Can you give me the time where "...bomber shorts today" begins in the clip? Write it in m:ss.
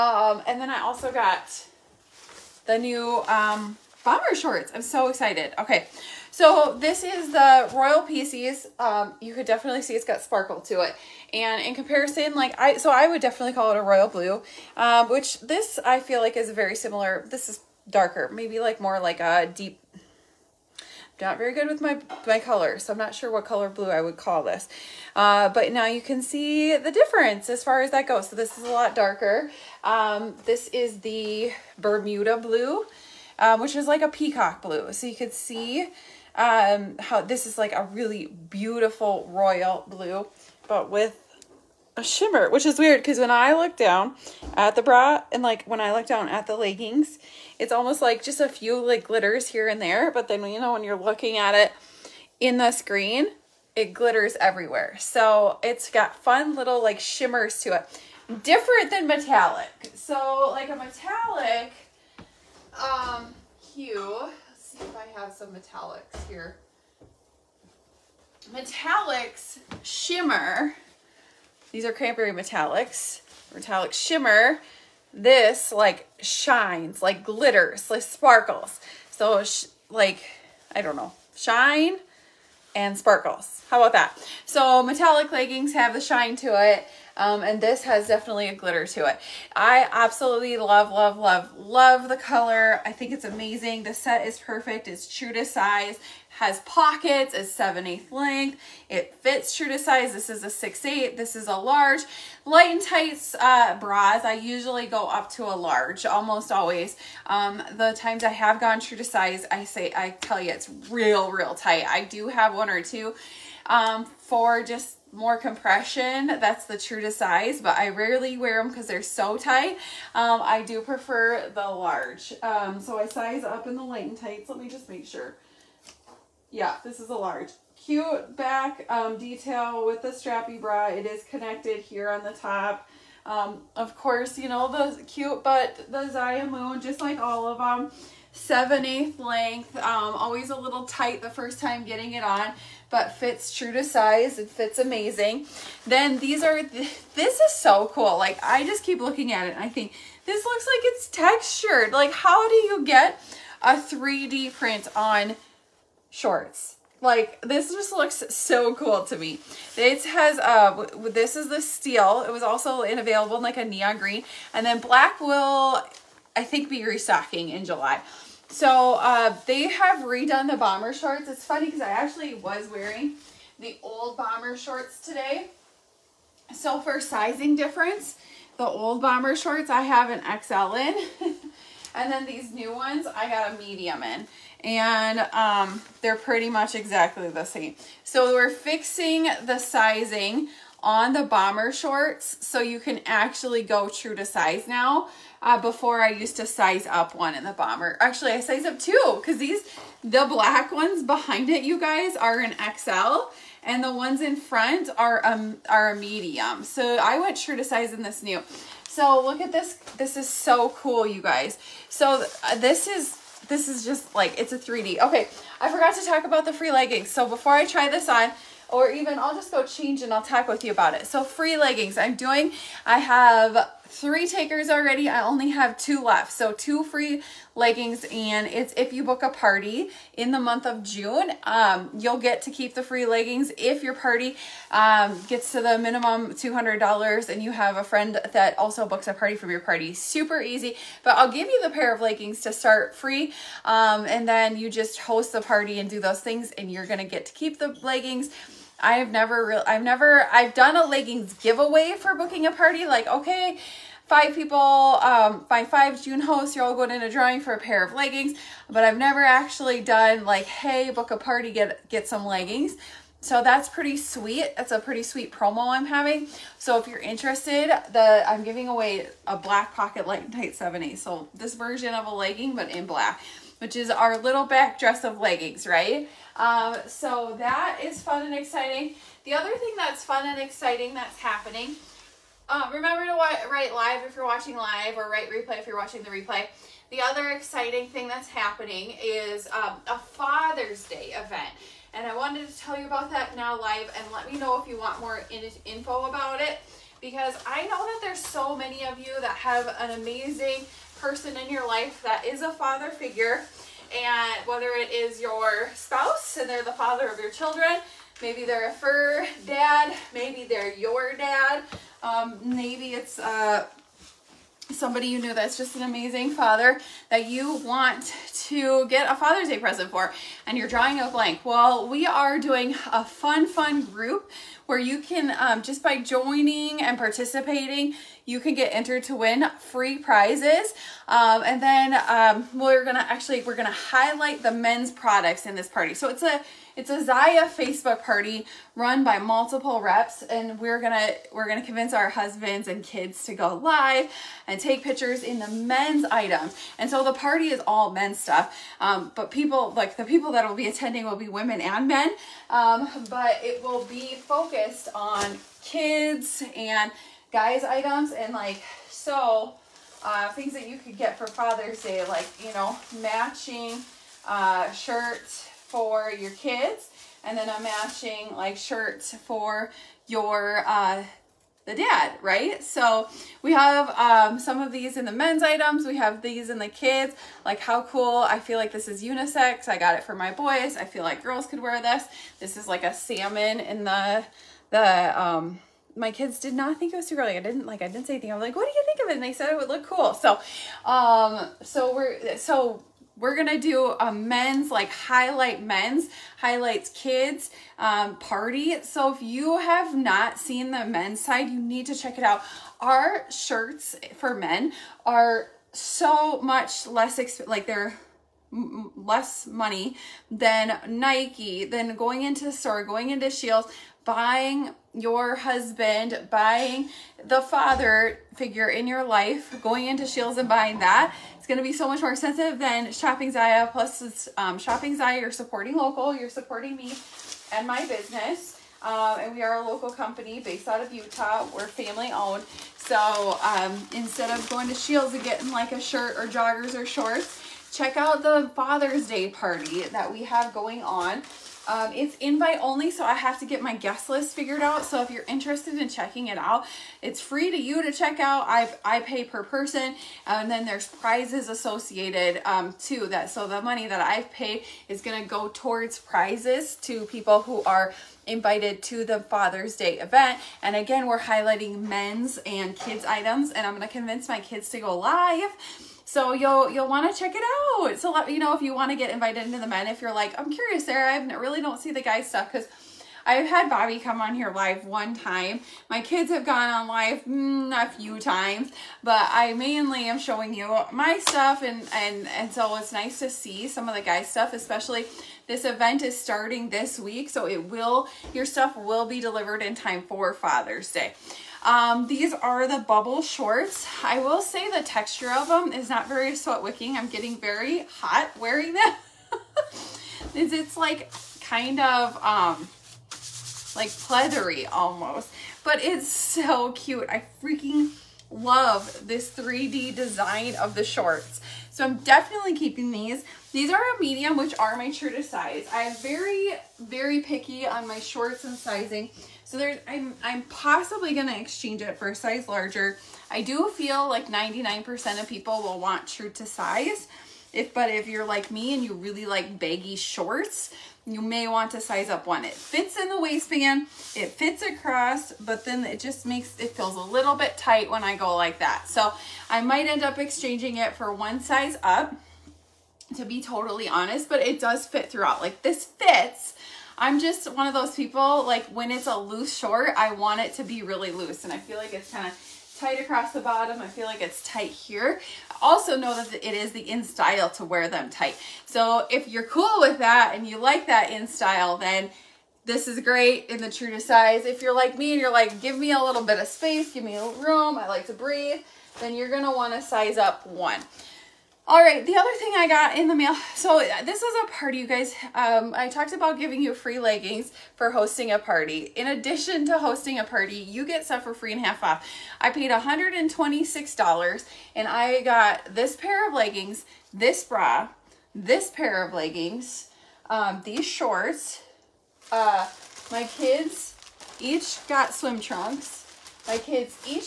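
2:54.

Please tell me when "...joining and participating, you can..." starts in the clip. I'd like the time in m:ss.
5:26.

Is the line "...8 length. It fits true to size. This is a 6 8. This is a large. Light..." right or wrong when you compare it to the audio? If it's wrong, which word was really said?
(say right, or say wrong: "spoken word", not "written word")
right.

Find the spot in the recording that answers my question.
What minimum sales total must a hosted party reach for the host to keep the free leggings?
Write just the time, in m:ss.
3:56.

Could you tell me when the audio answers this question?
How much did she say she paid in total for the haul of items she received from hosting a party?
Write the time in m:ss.
9:42.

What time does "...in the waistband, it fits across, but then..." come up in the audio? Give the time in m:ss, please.
8:52.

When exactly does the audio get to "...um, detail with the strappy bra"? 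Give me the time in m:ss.
2:08.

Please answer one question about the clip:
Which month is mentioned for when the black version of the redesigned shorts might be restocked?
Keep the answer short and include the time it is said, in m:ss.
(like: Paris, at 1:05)
July, at 2:47.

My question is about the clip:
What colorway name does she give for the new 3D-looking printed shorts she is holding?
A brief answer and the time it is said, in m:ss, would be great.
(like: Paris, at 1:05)
Steel, at 2:41.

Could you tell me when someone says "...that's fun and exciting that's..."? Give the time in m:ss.
4:39.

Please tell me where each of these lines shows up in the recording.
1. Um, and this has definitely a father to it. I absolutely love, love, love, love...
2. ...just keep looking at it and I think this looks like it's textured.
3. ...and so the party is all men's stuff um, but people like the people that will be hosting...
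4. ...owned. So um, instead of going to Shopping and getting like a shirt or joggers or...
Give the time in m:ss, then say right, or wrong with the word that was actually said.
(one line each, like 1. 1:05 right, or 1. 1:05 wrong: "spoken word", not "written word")
1. 1:27 wrong: "glitter", not "father"
2. 2:28 right
3. 5:46 wrong: "attending", not "hosting"
4. 7:12 wrong: "Scheels", not "Shopping".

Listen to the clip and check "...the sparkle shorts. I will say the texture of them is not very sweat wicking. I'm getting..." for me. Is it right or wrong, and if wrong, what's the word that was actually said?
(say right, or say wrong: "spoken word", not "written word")
wrong: "bubble", not "sparkle".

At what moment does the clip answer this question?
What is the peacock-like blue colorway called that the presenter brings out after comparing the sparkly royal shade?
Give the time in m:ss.
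0:31.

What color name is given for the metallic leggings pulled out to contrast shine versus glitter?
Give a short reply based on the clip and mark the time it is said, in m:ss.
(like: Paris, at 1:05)
Cranberry, at 1:11.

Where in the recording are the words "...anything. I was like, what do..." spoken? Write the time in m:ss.
6:28.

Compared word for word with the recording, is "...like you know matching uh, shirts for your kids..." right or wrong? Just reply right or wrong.
right.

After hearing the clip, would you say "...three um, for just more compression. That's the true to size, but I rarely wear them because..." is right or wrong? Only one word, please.
wrong.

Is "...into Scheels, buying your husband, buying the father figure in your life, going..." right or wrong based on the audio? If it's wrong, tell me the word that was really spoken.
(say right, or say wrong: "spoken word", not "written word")
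right.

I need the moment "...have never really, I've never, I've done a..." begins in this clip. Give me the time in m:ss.
4:08.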